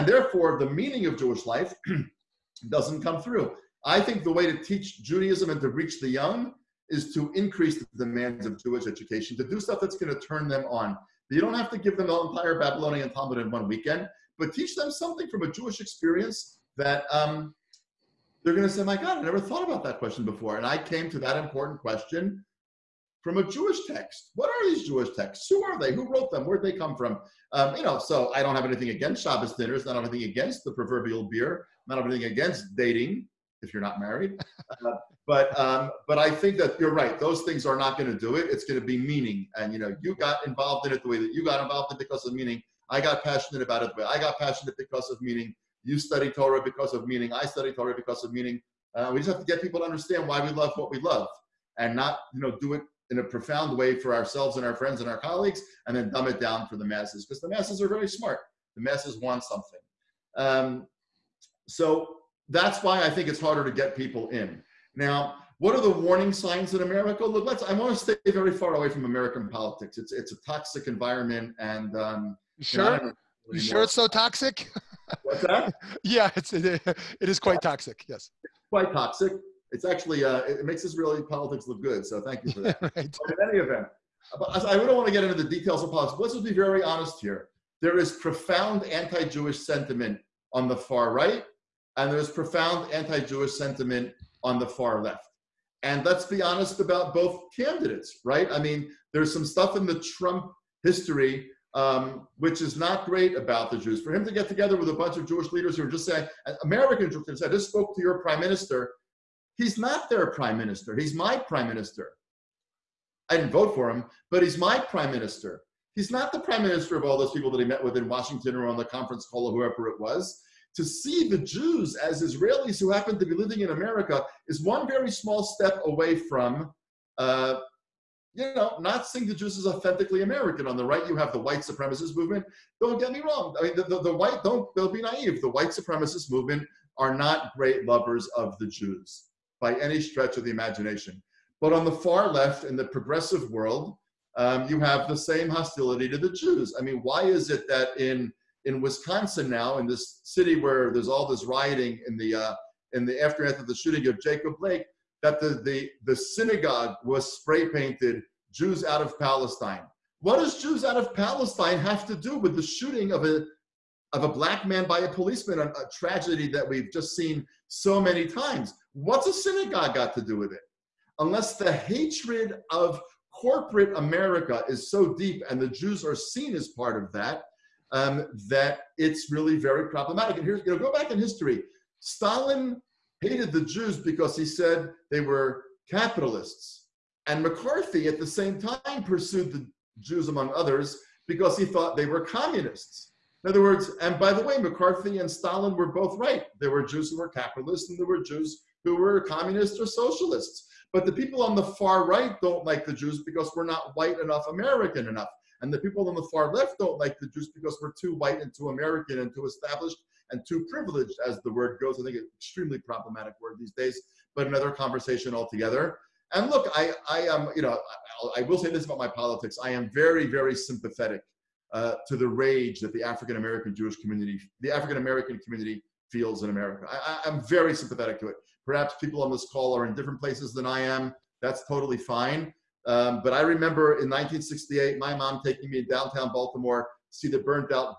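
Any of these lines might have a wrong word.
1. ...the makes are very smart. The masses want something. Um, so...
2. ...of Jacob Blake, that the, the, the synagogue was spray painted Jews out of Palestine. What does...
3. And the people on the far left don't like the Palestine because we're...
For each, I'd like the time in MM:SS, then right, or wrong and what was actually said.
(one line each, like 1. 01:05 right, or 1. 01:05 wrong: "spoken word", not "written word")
1. 00:57 wrong: "masses", not "makes"
2. 02:34 right
3. 03:25 wrong: "Jews", not "Palestine".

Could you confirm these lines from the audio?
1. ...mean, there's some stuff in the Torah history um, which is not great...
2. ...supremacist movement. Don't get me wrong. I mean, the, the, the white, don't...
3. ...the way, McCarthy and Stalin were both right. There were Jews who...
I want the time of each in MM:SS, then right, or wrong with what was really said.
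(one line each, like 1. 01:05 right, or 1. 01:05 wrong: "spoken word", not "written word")
1. 01:38 wrong: "Trump", not "Torah"
2. 02:11 right
3. 03:14 right.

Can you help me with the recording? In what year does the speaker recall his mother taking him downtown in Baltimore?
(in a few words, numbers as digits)
1968.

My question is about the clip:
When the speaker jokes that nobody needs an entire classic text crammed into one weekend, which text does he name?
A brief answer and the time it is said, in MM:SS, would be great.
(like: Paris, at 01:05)
Babylonian Talmud, at 00:12.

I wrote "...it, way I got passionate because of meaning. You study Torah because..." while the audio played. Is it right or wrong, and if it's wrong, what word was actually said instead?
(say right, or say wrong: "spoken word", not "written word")
right.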